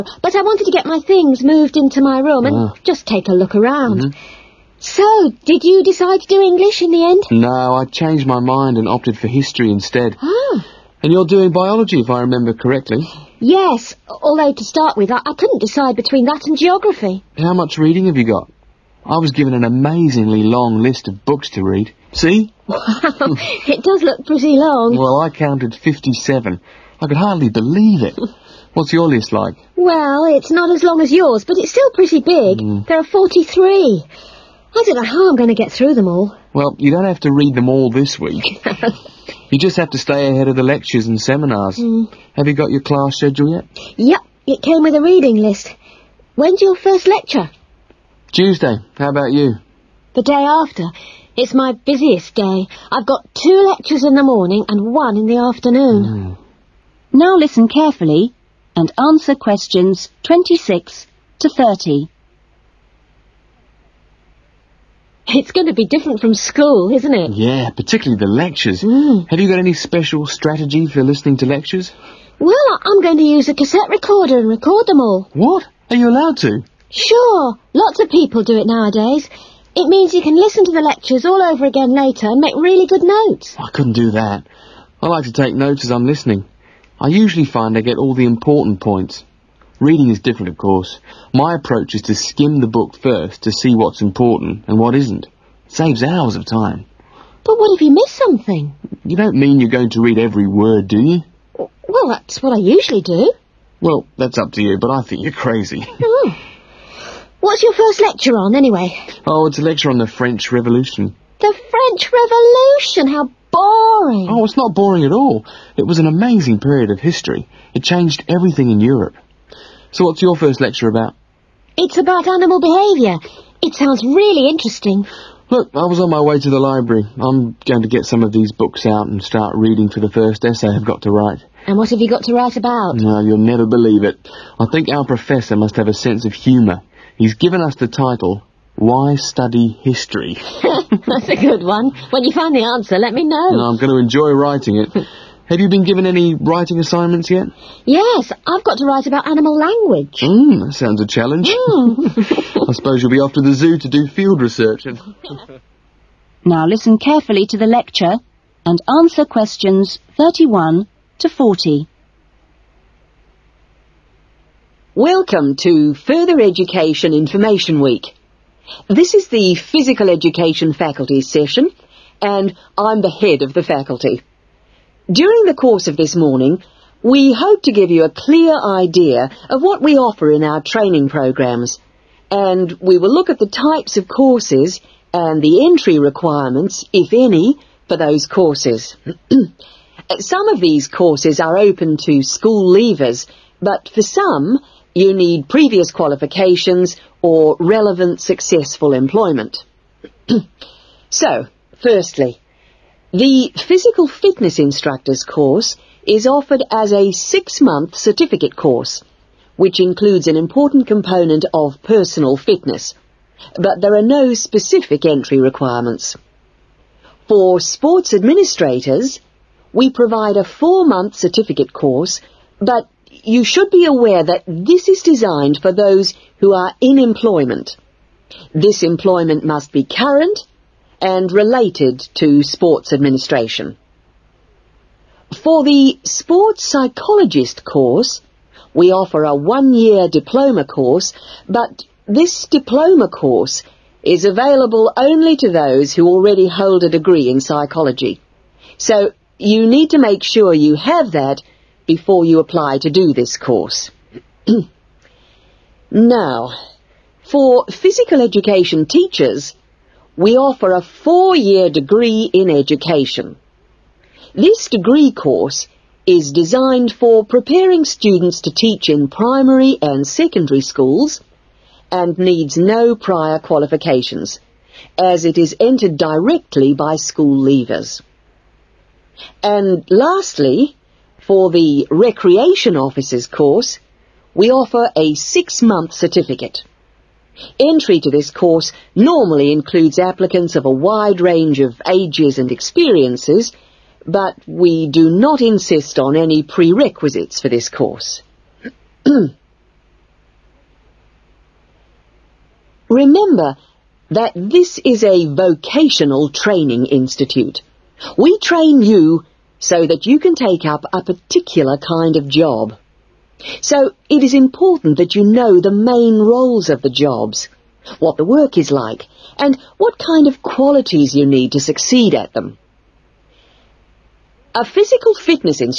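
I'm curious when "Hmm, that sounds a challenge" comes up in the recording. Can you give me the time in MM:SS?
02:30.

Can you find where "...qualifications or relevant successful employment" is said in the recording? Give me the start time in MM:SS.
03:15.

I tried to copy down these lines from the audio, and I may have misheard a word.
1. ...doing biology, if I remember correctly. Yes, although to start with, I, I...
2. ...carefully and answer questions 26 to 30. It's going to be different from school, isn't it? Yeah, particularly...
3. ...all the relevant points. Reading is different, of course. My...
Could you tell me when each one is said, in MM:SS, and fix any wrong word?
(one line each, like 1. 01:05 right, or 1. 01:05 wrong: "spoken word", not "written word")
1. 00:11 right
2. 00:57 right
3. 01:27 wrong: "important", not "relevant".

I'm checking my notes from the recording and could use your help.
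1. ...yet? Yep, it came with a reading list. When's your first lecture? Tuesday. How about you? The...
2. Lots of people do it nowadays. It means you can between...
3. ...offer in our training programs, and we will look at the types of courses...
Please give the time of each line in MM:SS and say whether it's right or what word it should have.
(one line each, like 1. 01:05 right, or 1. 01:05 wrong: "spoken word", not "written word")
1. 00:43 right
2. 01:17 wrong: "listen", not "between"
3. 02:59 right.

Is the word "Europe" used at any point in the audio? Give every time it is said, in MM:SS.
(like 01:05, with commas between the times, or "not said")
01:58.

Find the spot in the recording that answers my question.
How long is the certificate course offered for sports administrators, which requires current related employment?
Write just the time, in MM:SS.
03:40.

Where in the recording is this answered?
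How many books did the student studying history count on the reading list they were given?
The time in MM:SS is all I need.
00:25.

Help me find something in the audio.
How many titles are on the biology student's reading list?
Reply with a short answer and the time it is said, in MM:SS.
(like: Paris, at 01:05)
43, at 00:33.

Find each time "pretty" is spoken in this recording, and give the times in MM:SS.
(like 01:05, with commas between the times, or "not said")
00:24, 00:31.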